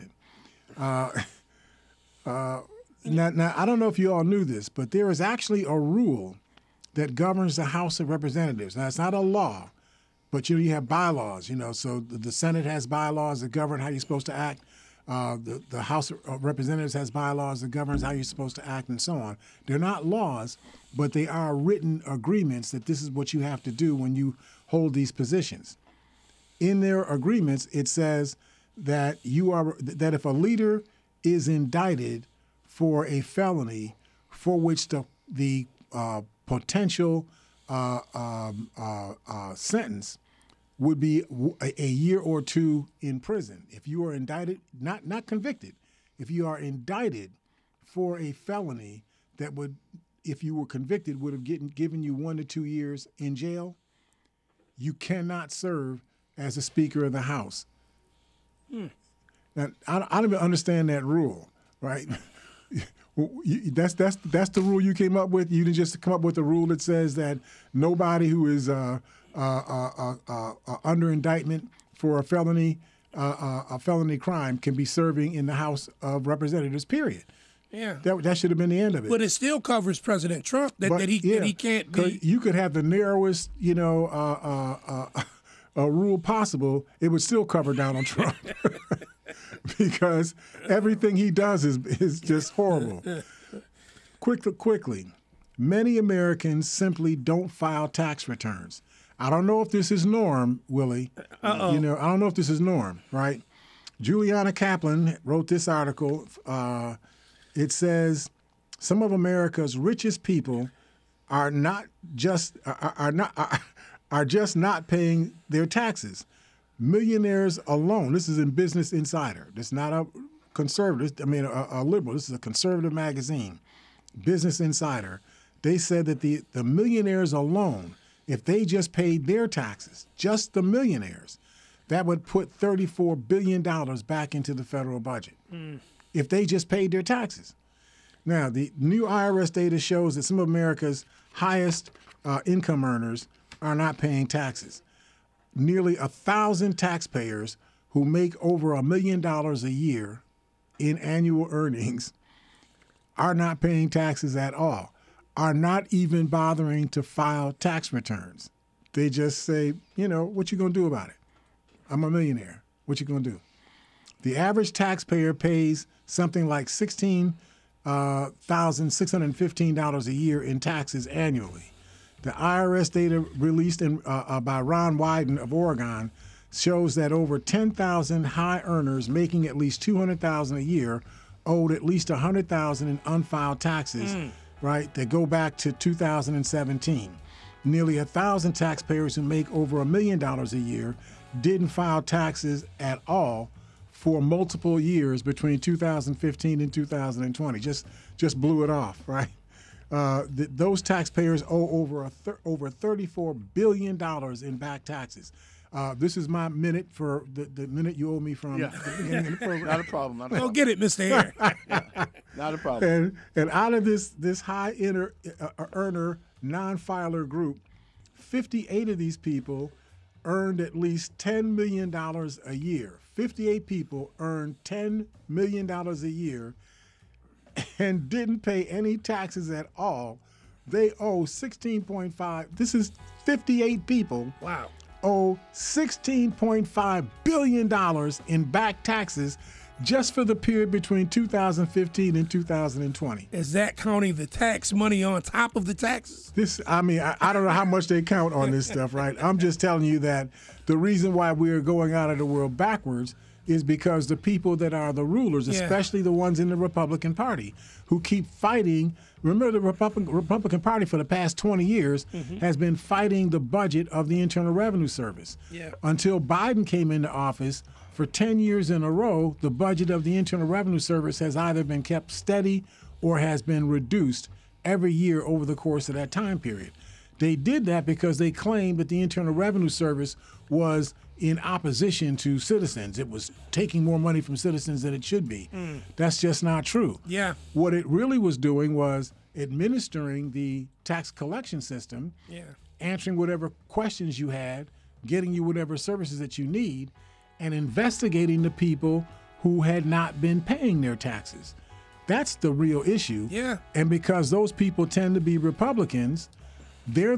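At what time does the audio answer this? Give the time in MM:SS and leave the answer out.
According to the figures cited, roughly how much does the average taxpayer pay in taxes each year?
02:46.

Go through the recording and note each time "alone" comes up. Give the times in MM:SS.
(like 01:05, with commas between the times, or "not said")
01:57, 02:07.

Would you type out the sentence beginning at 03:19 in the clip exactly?
Uh, th- those taxpayers owe over a over 34 billion dollars in back taxes.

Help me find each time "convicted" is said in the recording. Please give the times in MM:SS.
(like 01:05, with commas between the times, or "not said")
00:45, 00:50.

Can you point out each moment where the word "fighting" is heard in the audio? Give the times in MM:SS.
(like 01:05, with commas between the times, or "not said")
04:18, 04:22.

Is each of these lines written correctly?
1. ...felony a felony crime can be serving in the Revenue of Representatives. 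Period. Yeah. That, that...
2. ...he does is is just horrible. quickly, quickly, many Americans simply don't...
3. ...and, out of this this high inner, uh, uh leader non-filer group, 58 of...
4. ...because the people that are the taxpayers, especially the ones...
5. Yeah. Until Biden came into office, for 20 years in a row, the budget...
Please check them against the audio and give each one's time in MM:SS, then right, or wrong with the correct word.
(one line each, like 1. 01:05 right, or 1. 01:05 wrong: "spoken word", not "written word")
1. 01:12 wrong: "House", not "Revenue"
2. 01:31 right
3. 03:33 wrong: "earner", not "leader"
4. 04:13 wrong: "rulers", not "taxpayers"
5. 04:25 wrong: "10", not "20".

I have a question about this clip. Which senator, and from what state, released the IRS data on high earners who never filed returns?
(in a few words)
Ron Wyden of Oregon.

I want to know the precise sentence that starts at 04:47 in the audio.
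What it really was doing was administering the tax collection system, yeah.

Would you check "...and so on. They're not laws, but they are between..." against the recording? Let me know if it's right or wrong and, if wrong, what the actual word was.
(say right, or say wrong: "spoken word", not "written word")
wrong: "written", not "between".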